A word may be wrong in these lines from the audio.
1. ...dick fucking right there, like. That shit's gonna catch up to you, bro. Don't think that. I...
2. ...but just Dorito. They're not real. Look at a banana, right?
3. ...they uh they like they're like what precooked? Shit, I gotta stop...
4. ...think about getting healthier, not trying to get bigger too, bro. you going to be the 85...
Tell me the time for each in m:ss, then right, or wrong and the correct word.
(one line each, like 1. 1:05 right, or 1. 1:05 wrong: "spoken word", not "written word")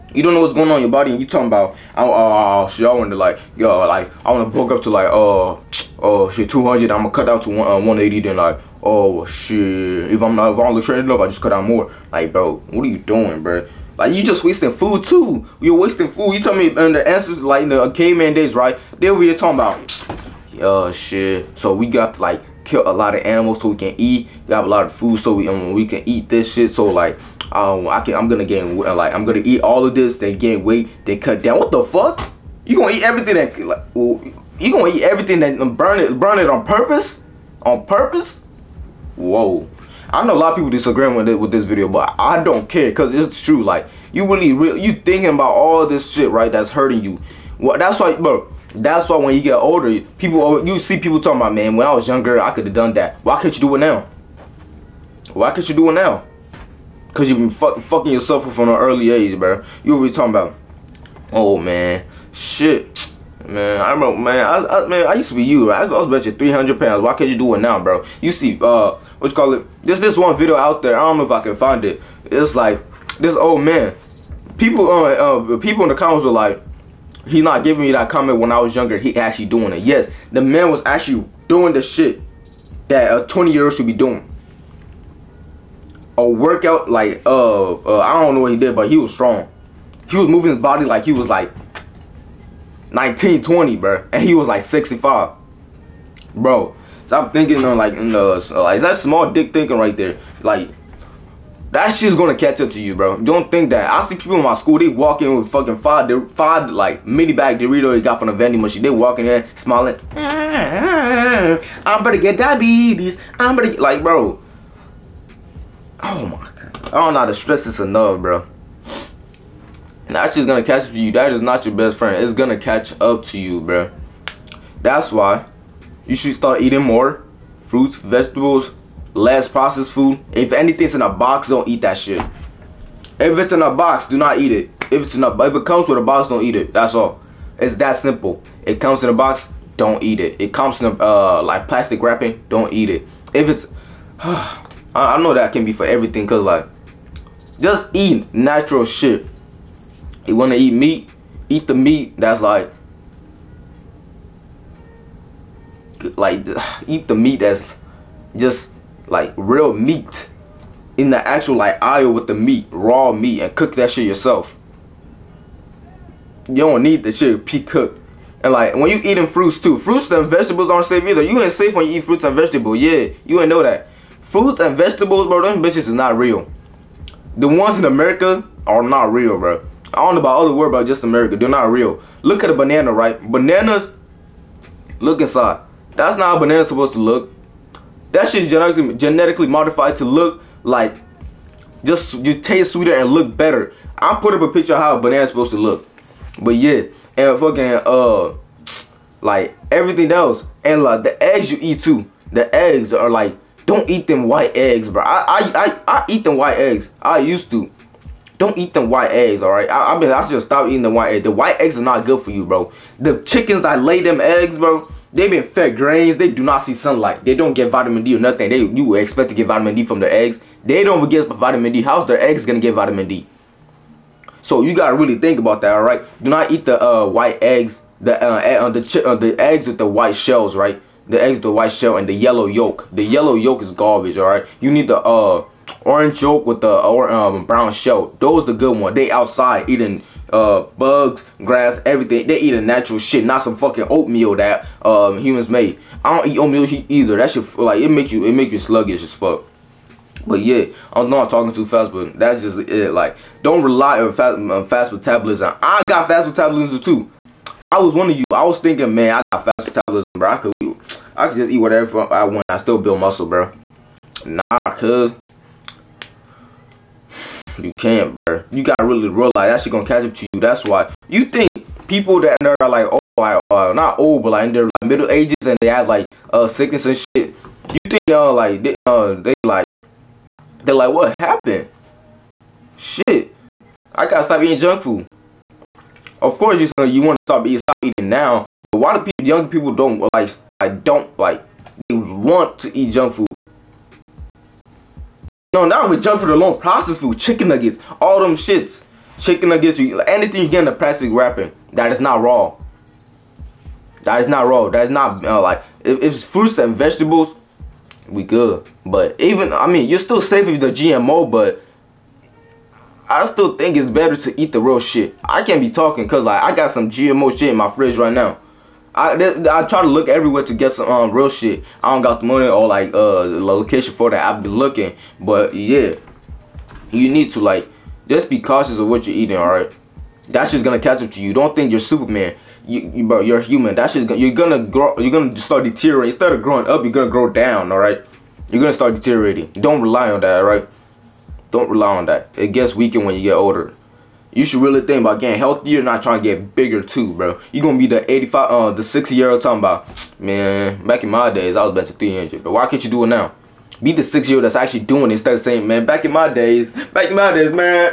1. 1:39 wrong: "thinking", not "fucking"
2. 3:00 wrong: "America", not "Dorito"
3. 4:38 wrong: "happened", not "precooked"
4. 5:44 right.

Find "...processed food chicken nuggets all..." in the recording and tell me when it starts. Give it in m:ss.
4:56.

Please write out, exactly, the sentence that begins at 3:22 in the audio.
The eggs are like don't eat them white eggs, bro.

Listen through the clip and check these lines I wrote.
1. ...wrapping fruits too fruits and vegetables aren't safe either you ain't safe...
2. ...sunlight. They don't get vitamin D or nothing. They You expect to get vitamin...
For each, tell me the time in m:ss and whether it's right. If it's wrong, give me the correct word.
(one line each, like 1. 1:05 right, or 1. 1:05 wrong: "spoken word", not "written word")
1. 2:49 wrong: "eating", not "wrapping"
2. 3:36 right.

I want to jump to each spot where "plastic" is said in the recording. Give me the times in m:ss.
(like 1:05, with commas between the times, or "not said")
2:21, 5:00.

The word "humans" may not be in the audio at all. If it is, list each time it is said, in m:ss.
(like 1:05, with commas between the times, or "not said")
4:05, 5:33.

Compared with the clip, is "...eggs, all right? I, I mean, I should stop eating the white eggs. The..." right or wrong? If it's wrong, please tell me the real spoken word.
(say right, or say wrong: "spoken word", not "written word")
right.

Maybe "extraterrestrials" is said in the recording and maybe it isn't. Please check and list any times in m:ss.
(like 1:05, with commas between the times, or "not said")
not said.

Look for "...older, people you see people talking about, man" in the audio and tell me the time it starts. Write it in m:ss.
0:49.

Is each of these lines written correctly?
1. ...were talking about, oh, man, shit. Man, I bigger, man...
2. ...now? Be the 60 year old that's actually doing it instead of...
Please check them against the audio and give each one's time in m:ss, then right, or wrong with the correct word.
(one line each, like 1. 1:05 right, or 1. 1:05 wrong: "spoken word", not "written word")
1. 0:59 wrong: "remember", not "bigger"
2. 5:53 right.